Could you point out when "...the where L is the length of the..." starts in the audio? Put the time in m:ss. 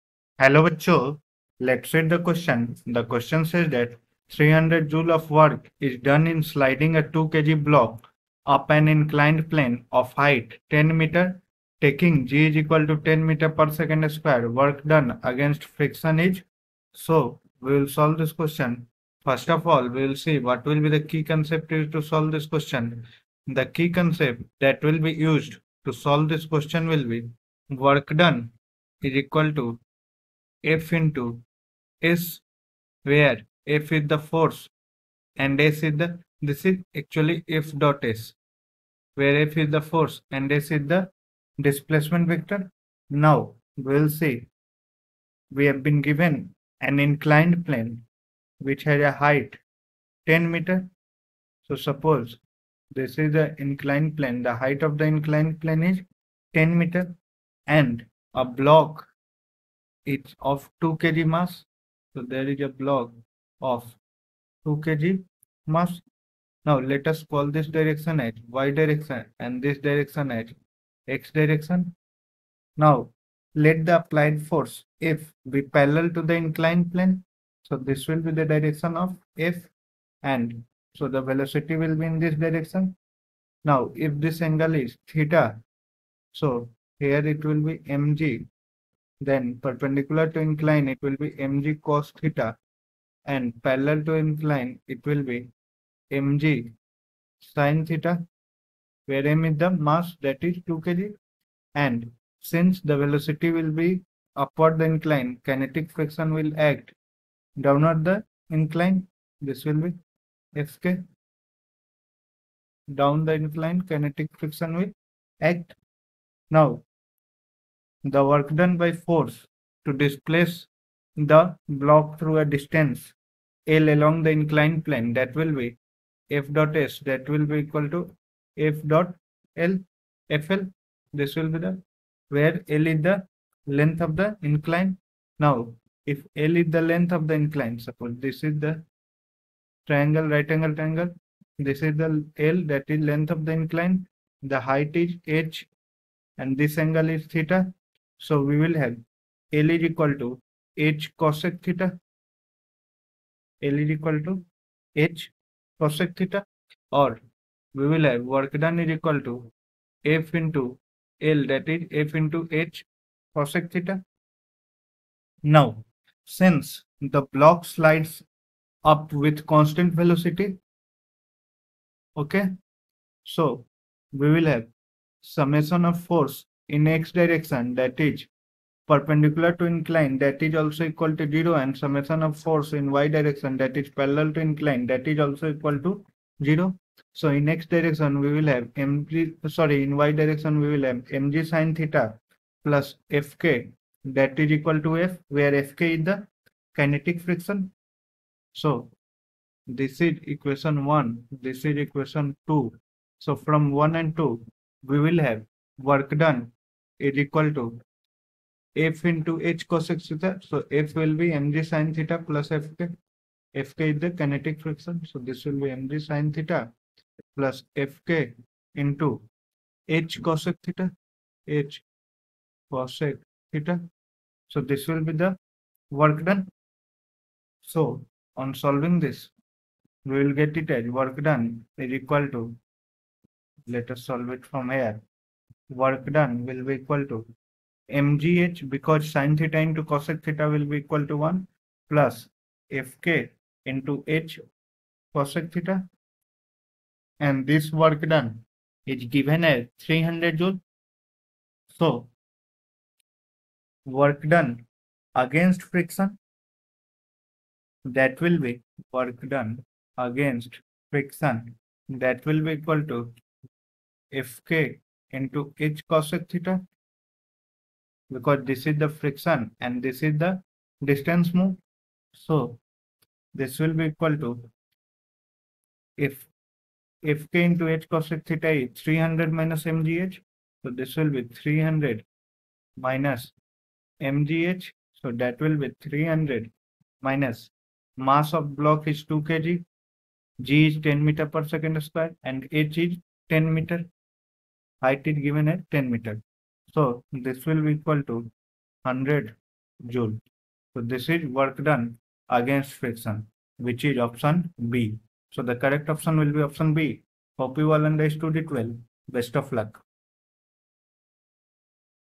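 2:11.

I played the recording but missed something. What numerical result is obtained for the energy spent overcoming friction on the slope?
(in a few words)
100 joules.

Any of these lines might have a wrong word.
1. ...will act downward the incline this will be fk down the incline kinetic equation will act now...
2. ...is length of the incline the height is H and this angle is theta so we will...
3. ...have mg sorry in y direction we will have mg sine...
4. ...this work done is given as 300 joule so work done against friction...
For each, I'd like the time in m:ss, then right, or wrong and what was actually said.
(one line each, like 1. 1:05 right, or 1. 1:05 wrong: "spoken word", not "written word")
1. 1:46 wrong: "friction", not "equation"
2. 2:22 right
3. 3:08 right
4. 4:07 right.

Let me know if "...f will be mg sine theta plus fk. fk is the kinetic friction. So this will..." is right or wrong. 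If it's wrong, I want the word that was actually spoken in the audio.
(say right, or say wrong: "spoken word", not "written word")
right.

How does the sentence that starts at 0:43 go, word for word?
Now we'll see we have been given an inclined plane which has a height 10 meter.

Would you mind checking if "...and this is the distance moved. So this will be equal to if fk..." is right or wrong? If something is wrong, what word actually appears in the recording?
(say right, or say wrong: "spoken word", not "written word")
right.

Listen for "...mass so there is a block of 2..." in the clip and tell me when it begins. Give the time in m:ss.
1:01.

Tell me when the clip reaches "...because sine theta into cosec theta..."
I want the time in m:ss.
3:58.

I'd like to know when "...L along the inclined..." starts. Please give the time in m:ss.
2:03.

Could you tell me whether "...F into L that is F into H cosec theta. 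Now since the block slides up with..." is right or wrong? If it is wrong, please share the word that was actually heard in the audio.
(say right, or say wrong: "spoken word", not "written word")
right.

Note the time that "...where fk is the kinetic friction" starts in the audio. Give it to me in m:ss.
3:15.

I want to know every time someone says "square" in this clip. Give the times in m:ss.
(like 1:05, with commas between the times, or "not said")
0:14, 4:51.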